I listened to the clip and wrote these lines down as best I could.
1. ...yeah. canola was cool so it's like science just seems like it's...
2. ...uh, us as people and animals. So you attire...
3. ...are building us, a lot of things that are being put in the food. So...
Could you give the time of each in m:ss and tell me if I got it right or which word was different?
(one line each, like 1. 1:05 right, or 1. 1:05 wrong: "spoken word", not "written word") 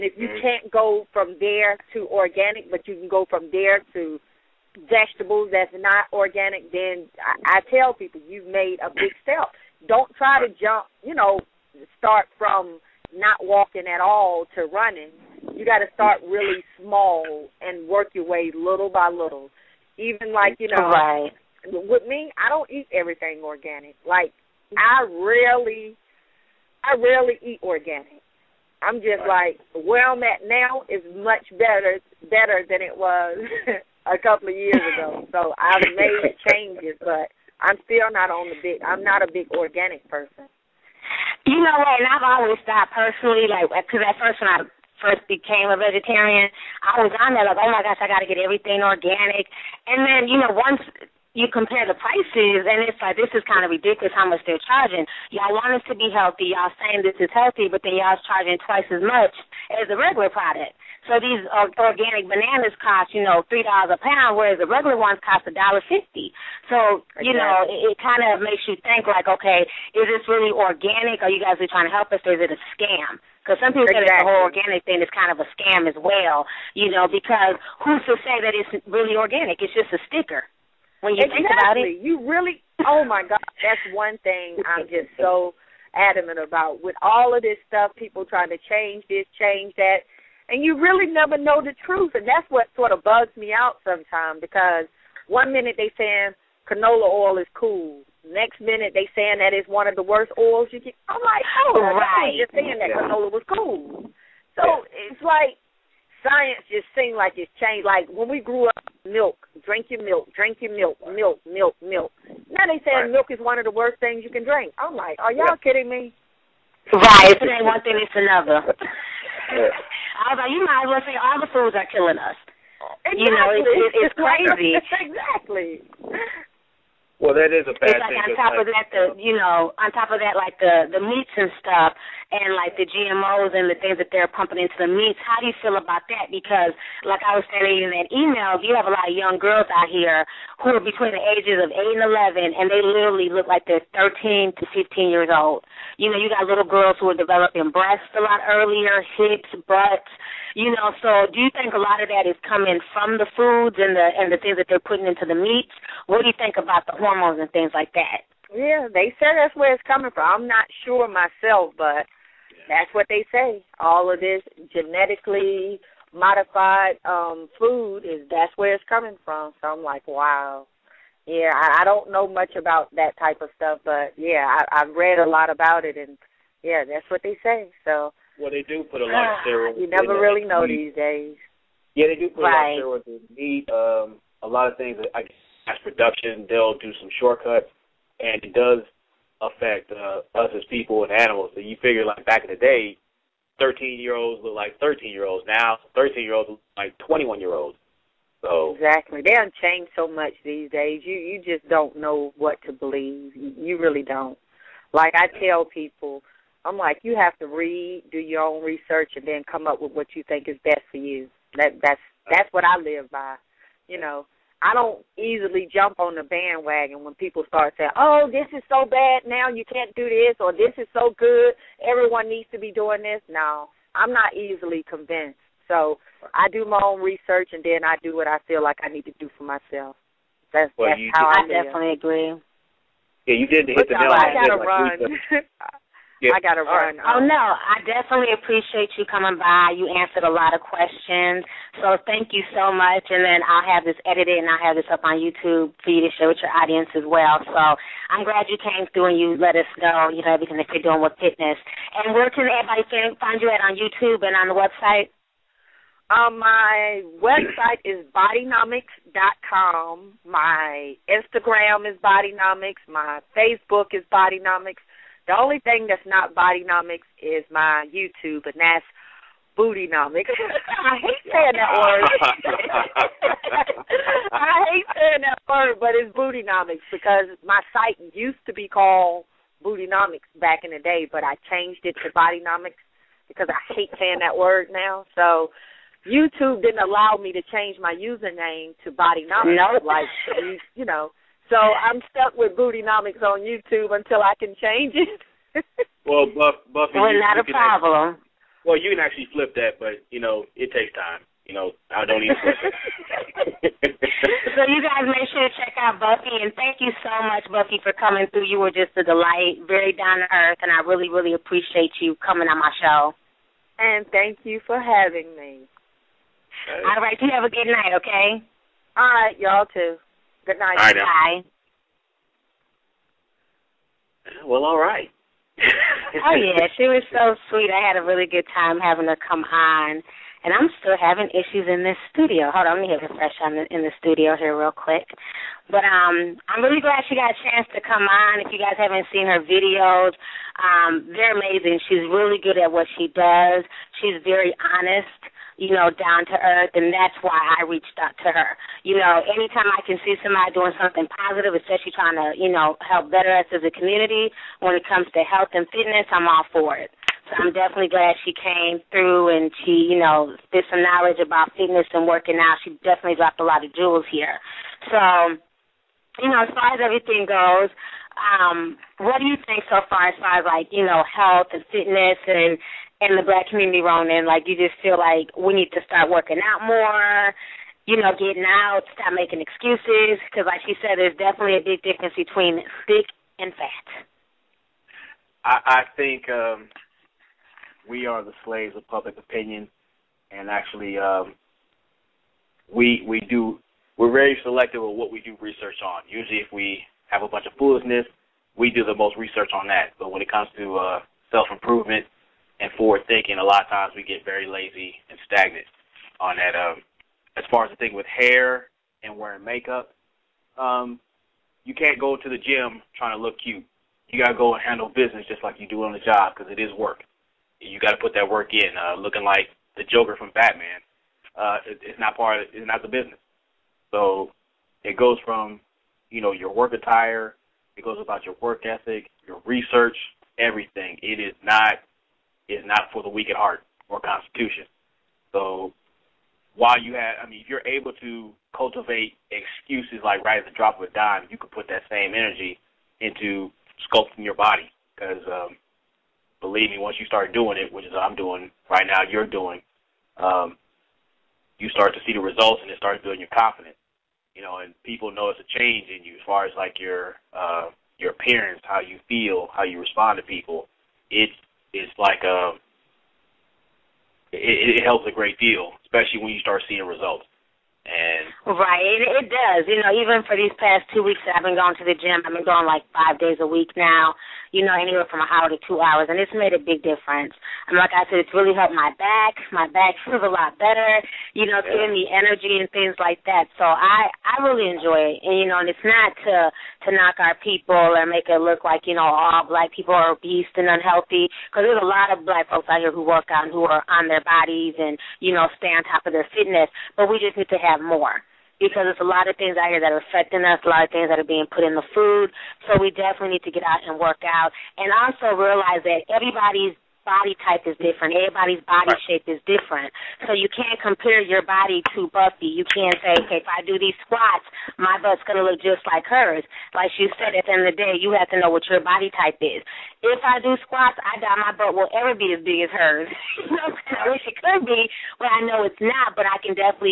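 1. 1:42 right
2. 3:09 wrong: "figure", not "attire"
3. 8:19 wrong: "affecting", not "building".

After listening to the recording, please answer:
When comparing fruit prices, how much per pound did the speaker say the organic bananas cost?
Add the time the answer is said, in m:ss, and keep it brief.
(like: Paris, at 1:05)
$3, at 1:03.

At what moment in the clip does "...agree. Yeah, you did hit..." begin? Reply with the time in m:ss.
3:51.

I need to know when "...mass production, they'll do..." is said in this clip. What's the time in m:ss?
3:05.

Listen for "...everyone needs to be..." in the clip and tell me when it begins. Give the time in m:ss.
3:41.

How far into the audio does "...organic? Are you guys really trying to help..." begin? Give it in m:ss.
1:10.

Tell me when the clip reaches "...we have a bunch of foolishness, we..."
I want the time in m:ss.
6:36.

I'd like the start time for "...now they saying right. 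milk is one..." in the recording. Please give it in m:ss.
1:52.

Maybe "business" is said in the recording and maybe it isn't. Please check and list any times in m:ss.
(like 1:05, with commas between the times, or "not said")
6:54, 7:02.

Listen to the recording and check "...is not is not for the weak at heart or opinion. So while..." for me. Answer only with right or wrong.
wrong.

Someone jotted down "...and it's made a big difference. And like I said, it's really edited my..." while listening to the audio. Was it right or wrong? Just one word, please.
wrong.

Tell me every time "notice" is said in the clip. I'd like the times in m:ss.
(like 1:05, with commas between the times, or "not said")
7:35.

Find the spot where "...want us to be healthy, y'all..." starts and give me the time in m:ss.
0:55.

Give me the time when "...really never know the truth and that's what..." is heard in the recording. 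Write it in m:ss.
1:30.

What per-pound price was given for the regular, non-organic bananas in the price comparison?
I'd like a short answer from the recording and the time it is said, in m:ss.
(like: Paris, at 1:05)
$1.50, at 1:05.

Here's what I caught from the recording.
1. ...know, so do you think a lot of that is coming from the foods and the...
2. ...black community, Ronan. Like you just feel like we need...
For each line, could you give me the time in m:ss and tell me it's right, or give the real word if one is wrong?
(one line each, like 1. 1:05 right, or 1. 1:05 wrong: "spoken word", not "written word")
1. 2:30 right
2. 6:13 right.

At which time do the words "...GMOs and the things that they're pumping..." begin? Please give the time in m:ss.
2:12.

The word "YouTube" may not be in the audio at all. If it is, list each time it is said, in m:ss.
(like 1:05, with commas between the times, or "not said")
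4:05, 4:13, 4:27, 4:46, 4:53.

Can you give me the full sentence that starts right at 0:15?
You got to start really small and work your way little by little.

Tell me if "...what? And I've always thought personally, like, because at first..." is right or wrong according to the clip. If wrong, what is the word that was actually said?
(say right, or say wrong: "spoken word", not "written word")
right.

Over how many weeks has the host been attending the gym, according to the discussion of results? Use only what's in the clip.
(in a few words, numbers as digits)
2.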